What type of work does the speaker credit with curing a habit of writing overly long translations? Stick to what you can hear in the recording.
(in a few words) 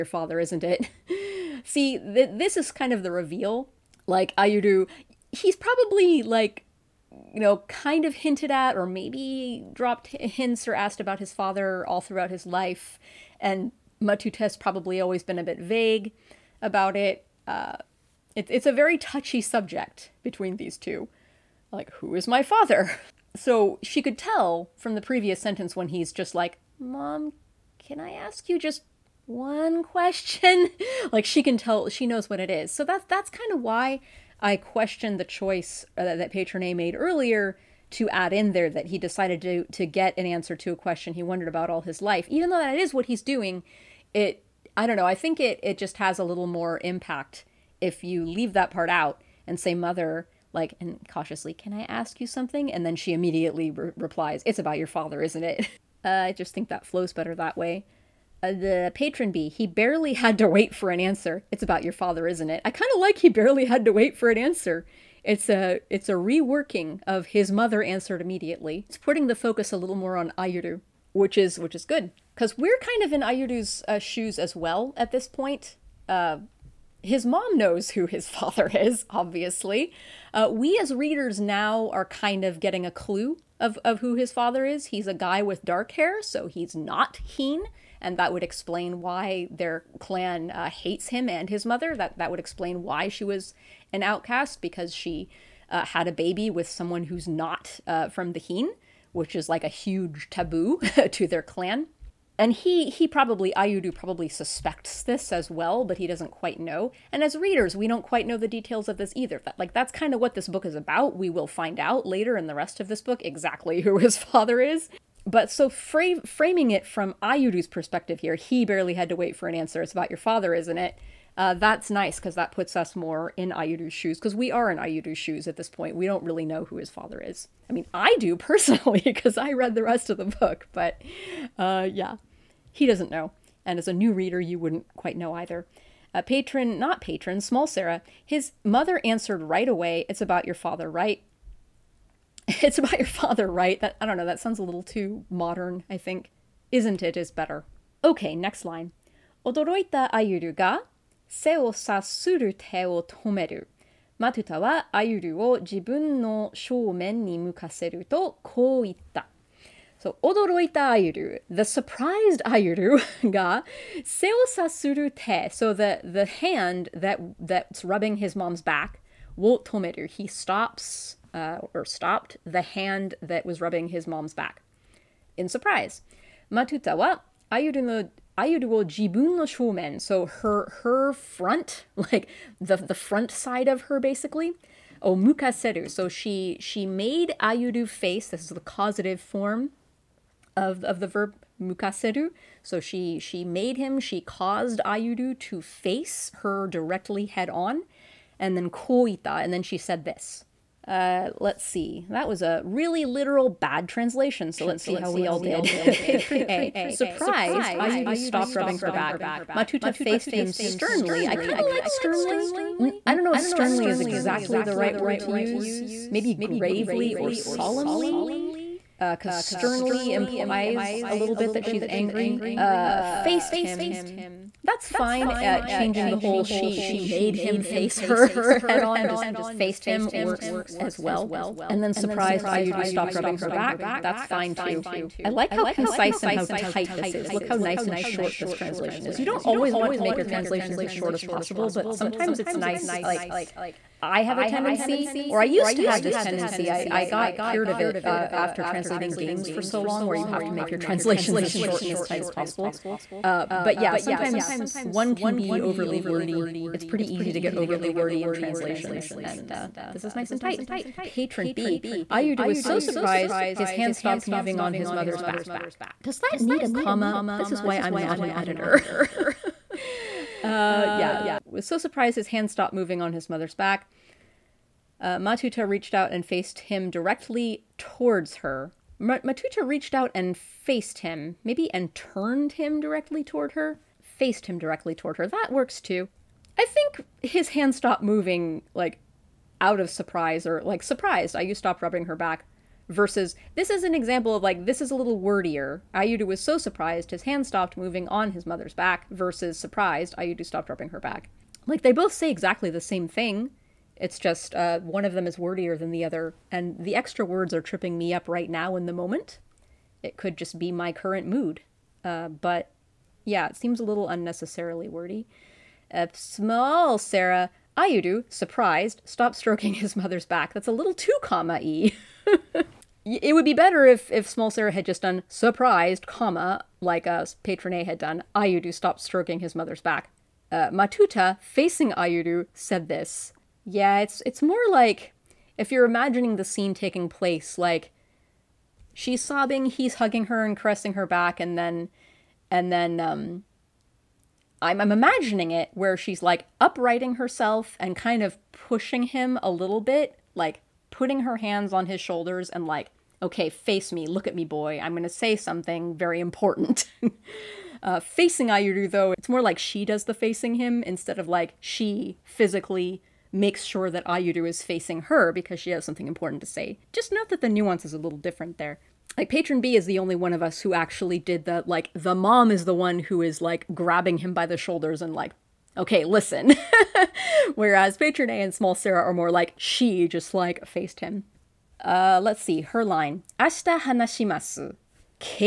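translating games.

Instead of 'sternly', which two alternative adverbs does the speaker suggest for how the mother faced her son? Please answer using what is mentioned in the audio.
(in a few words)
gravely or solemnly.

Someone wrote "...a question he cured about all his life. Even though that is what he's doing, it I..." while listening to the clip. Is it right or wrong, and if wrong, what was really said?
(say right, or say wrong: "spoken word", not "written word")
wrong: "wondered", not "cured".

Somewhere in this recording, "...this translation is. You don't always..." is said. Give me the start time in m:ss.
3:58.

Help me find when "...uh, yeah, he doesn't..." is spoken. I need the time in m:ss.
2:11.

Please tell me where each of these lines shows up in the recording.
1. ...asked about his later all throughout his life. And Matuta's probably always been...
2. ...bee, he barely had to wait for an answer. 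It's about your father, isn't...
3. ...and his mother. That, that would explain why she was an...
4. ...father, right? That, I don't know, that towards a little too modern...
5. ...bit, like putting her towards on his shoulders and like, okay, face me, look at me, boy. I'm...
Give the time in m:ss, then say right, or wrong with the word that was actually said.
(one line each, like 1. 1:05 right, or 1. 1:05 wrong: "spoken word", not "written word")
1. 0:10 wrong: "father", not "later"
2. 0:59 right
3. 1:31 right
4. 2:23 wrong: "sounds", not "towards"
5. 5:49 wrong: "hands", not "towards".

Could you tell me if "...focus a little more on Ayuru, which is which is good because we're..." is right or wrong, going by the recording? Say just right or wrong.
right.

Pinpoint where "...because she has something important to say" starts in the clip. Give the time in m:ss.
6:05.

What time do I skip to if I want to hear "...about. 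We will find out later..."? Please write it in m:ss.
1:50.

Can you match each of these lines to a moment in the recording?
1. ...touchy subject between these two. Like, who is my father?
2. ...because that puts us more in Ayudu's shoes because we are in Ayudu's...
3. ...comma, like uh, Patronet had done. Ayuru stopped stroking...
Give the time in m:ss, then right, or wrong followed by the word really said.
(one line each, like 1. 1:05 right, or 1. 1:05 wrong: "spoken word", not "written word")
1. 0:18 right
2. 2:02 right
3. 5:26 right.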